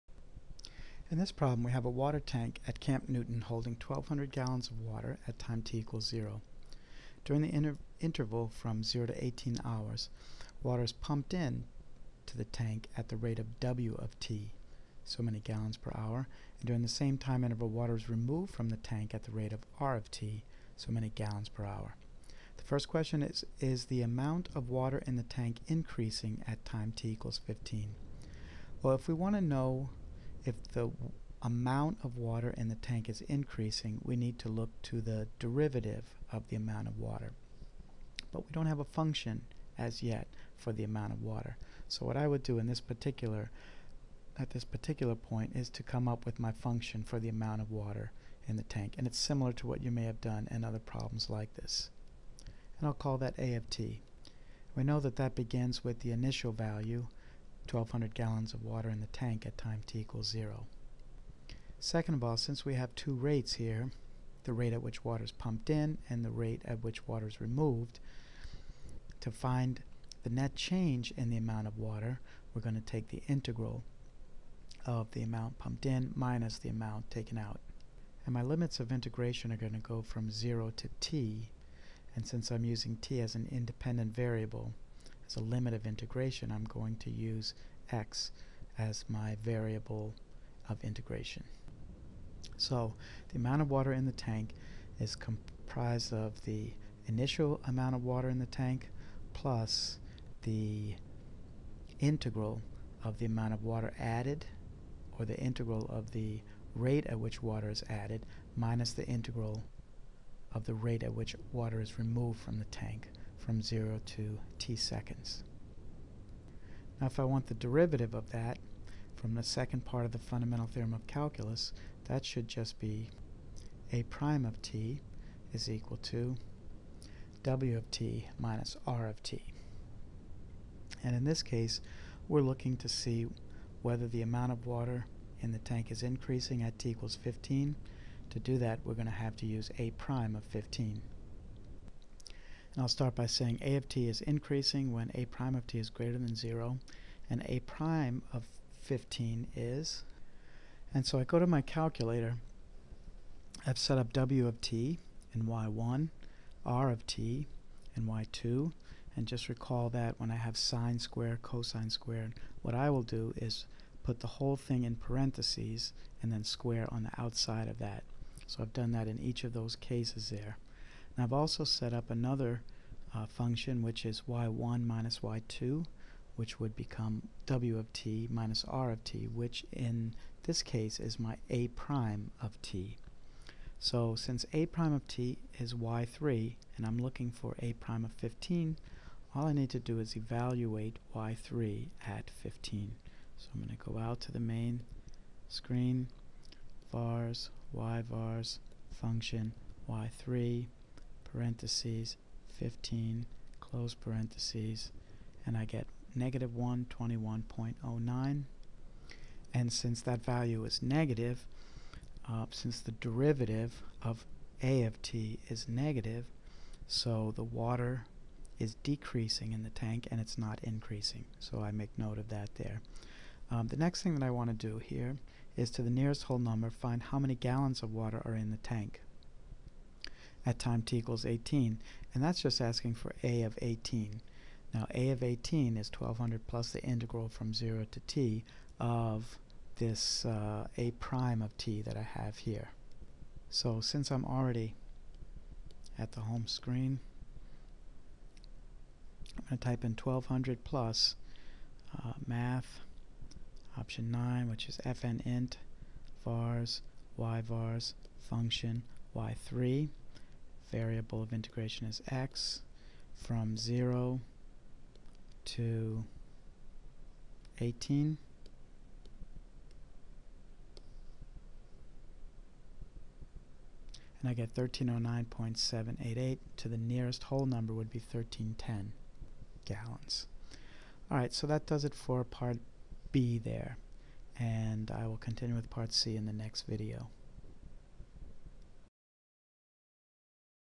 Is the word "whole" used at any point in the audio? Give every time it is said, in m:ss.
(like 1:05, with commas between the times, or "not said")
2:44, 3:46, 4:37.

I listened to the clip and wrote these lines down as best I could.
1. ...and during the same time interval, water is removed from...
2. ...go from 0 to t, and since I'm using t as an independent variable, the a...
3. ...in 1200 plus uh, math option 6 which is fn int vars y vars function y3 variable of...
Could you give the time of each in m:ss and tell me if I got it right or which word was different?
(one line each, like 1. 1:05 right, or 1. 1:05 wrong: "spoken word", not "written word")
1. 0:16 right
2. 1:19 right
3. 4:09 wrong: "9", not "6".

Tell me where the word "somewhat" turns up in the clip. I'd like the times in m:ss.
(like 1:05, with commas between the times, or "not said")
not said.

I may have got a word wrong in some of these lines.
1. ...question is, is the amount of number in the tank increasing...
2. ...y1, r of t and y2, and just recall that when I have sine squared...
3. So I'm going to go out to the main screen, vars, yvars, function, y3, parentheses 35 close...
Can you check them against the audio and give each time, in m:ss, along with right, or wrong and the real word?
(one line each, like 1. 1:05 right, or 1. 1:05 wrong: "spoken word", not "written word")
1. 0:22 wrong: "water", not "number"
2. 2:35 right
3. 3:13 wrong: "15", not "35".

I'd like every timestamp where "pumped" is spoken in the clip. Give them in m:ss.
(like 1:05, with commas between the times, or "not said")
0:10, 1:05, 1:15.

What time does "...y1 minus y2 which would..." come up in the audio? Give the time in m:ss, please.
2:54.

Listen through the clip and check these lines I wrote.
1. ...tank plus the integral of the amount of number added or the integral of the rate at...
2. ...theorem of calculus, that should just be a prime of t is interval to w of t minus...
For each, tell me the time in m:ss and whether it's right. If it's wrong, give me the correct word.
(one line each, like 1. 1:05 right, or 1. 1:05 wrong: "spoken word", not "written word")
1. 1:38 wrong: "water", not "number"
2. 2:00 wrong: "equal", not "interval".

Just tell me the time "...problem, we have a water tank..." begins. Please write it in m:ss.
0:01.